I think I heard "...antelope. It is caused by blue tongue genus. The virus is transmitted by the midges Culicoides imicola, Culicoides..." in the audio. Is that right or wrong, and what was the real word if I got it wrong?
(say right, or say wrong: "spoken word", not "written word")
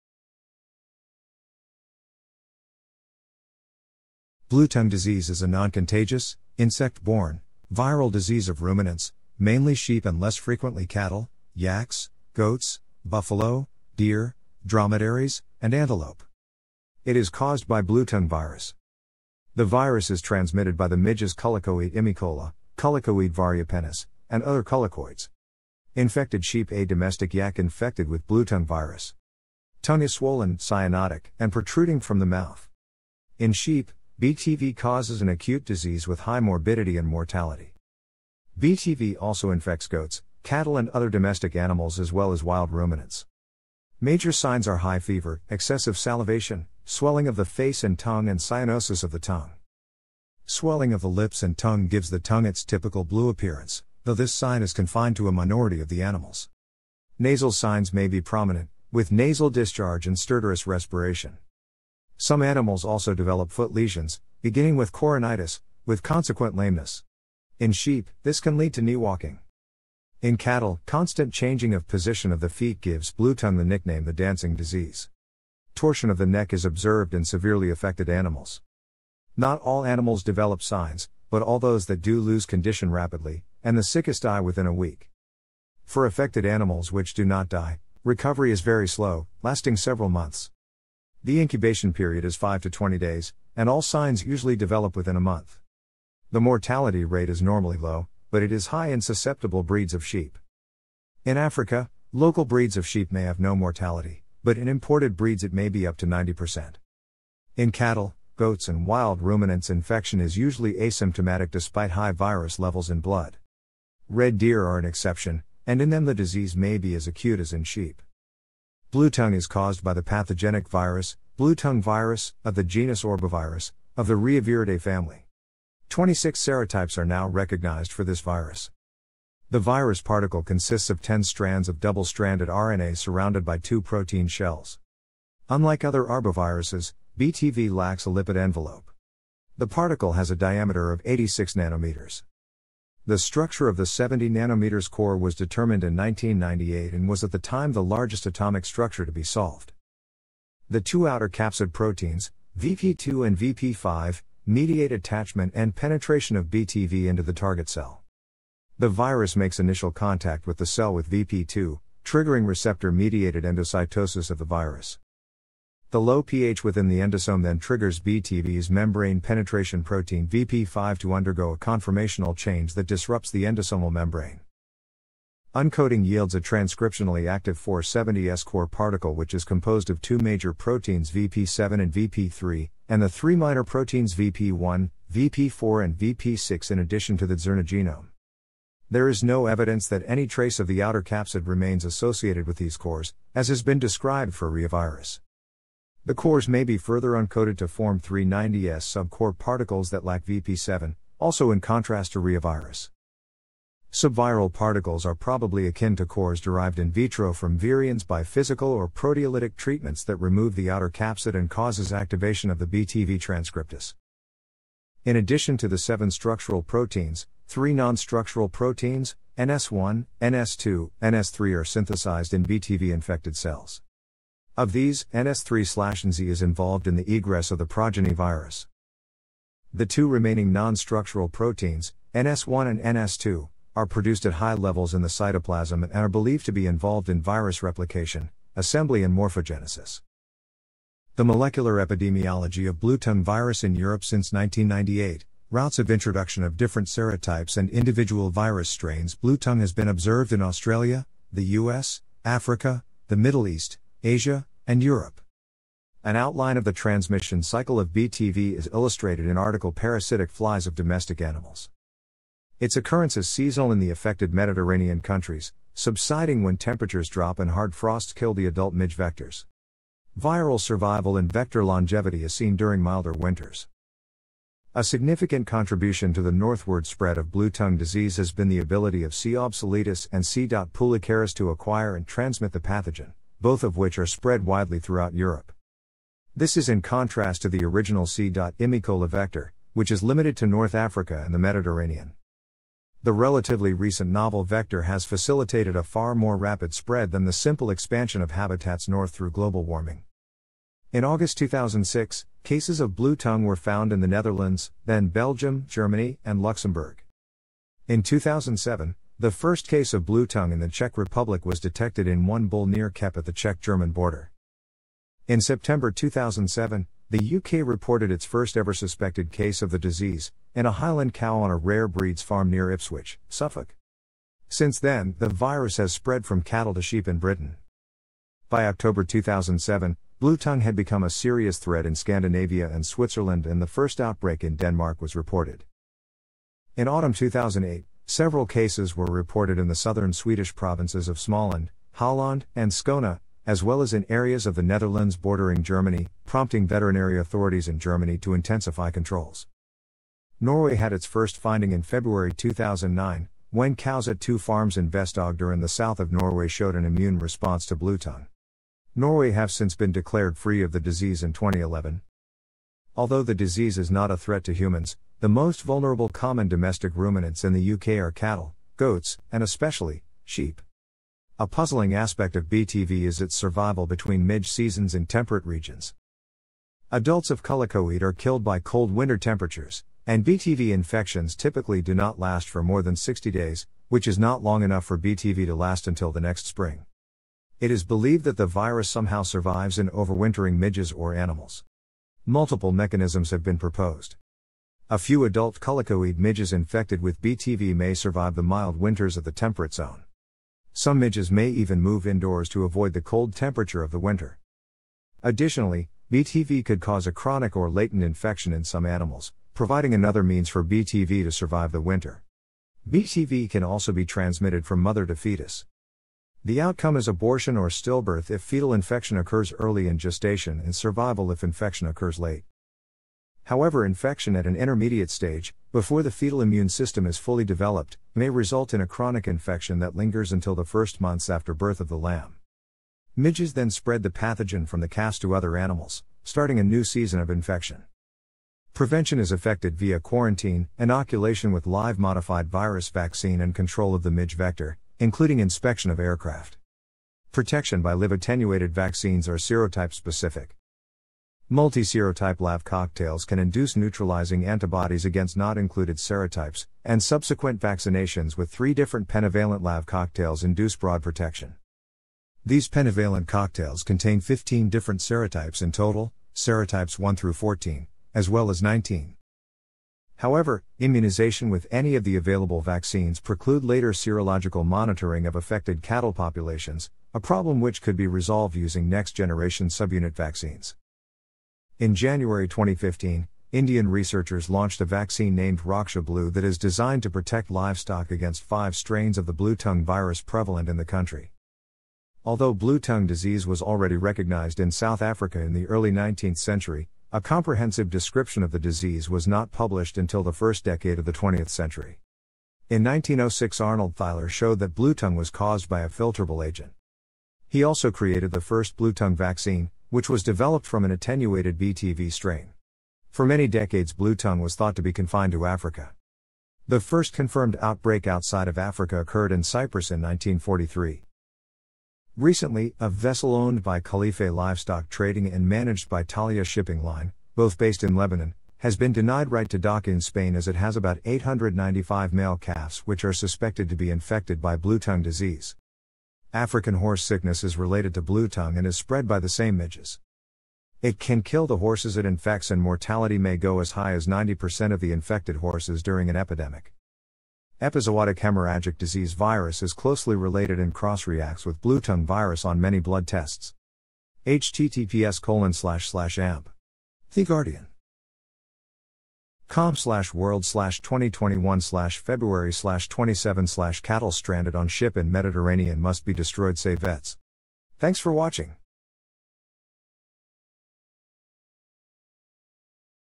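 wrong: "virus", not "genus".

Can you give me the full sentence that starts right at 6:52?
BTV can also be transmitted from mother to fetus.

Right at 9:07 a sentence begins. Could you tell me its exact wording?
Epizootic hemorrhagic disease virus is closely related and cross reacts with blue tongue virus on many blood tests.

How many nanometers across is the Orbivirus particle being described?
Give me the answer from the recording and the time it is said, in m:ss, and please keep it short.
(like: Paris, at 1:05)
86 nanometers, at 2:21.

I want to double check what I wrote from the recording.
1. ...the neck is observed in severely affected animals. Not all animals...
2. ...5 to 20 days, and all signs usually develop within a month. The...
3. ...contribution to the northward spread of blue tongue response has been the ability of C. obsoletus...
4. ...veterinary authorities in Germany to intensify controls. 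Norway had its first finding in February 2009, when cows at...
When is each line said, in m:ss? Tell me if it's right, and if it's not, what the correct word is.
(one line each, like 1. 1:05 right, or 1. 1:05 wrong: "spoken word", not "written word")
1. 1:16 right
2. 1:32 right
3. 4:35 wrong: "disease", not "response"
4. 5:46 right.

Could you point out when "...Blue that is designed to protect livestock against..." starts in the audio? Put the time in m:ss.
8:06.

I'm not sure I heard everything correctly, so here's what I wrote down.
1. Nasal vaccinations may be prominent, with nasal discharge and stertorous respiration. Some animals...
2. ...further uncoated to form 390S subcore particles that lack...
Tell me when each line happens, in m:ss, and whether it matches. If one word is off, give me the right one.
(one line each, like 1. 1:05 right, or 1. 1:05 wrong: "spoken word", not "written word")
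1. 0:57 wrong: "signs", not "vaccinations"
2. 3:16 right.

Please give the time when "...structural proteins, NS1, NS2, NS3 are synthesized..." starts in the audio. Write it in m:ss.
3:37.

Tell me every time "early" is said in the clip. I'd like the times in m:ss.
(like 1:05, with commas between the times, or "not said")
6:59, 8:15.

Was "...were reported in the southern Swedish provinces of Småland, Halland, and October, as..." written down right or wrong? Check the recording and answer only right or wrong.
wrong.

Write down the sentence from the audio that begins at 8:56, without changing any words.
African horse sickness is related to blue tongue and is spread by the same midges.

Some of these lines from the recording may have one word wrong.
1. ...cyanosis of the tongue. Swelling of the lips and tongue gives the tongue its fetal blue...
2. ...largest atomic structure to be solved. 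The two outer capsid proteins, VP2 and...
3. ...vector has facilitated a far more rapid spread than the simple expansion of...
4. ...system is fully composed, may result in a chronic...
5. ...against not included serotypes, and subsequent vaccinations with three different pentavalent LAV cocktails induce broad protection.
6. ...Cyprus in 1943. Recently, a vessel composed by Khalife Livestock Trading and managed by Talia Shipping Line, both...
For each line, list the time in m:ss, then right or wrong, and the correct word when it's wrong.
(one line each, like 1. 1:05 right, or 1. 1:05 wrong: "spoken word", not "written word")
1. 0:48 wrong: "typical", not "fetal"
2. 2:27 right
3. 4:54 right
4. 7:06 wrong: "developed", not "composed"
5. 7:35 right
6. 8:39 wrong: "owned", not "composed".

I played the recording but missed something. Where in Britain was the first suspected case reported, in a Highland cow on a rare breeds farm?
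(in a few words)
Ipswich, Suffolk.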